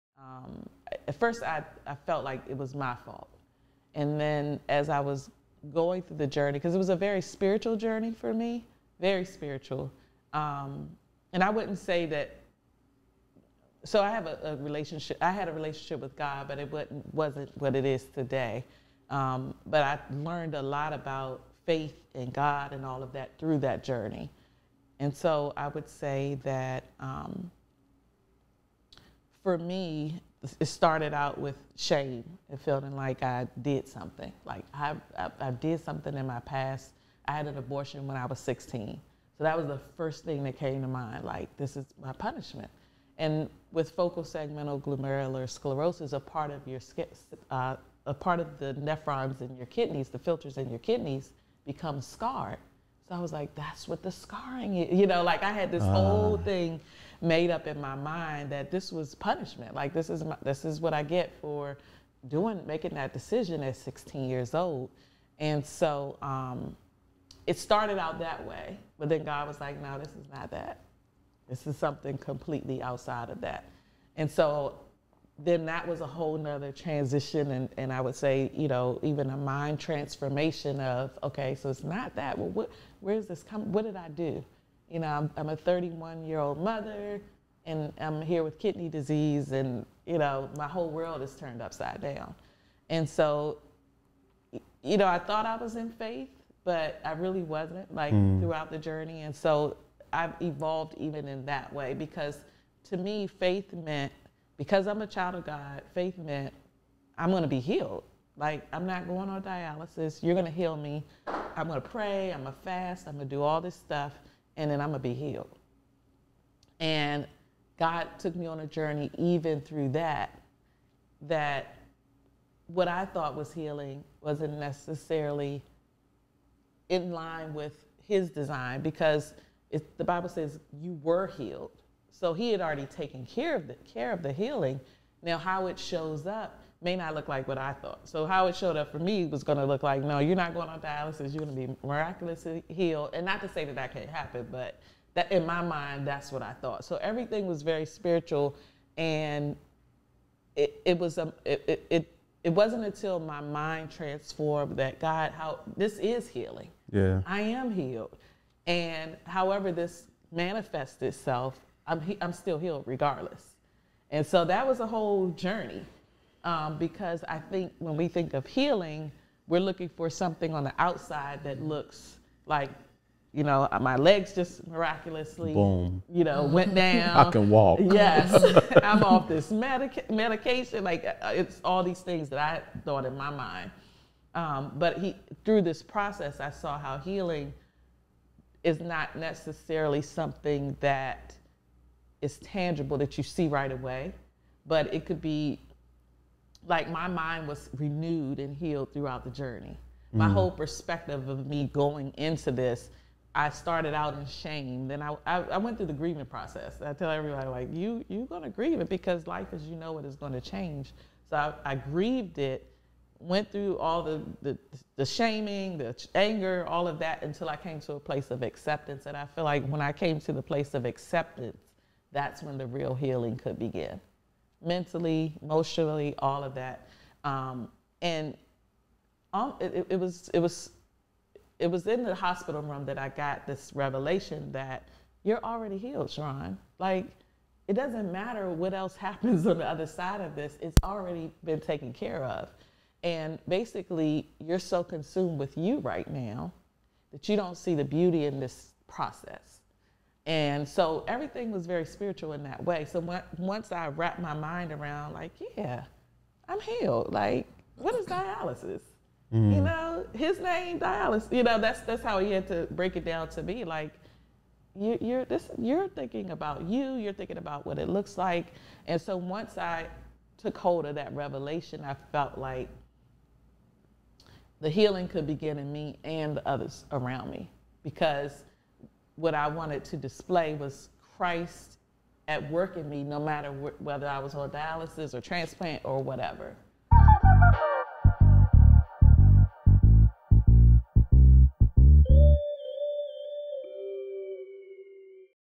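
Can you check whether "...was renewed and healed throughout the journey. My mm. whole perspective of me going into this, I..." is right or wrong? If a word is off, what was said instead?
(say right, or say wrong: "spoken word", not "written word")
right.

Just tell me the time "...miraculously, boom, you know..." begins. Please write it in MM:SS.
02:54.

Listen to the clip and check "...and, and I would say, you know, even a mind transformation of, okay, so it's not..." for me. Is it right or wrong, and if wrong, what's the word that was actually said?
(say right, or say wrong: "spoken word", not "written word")
right.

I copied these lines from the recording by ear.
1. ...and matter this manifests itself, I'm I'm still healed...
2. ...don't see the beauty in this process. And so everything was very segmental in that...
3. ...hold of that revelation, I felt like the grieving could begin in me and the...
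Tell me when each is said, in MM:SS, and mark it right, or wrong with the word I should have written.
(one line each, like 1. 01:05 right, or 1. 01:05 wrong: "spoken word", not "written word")
1. 02:38 wrong: "however", not "matter"
2. 04:07 wrong: "spiritual", not "segmental"
3. 04:30 wrong: "healing", not "grieving".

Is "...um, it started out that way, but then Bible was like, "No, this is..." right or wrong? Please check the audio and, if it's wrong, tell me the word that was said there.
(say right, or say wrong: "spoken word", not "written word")
wrong: "God", not "Bible".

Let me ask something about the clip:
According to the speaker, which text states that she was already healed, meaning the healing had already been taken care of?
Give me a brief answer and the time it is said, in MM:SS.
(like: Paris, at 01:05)
The Bible, at 02:09.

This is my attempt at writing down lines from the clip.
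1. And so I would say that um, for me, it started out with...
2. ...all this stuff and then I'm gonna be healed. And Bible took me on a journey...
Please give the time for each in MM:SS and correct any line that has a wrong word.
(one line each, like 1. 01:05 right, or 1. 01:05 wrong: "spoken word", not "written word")
1. 00:24 right
2. 01:53 wrong: "God", not "Bible".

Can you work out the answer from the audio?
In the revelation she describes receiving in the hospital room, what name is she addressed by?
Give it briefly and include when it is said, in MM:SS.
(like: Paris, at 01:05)
Sharron, at 03:56.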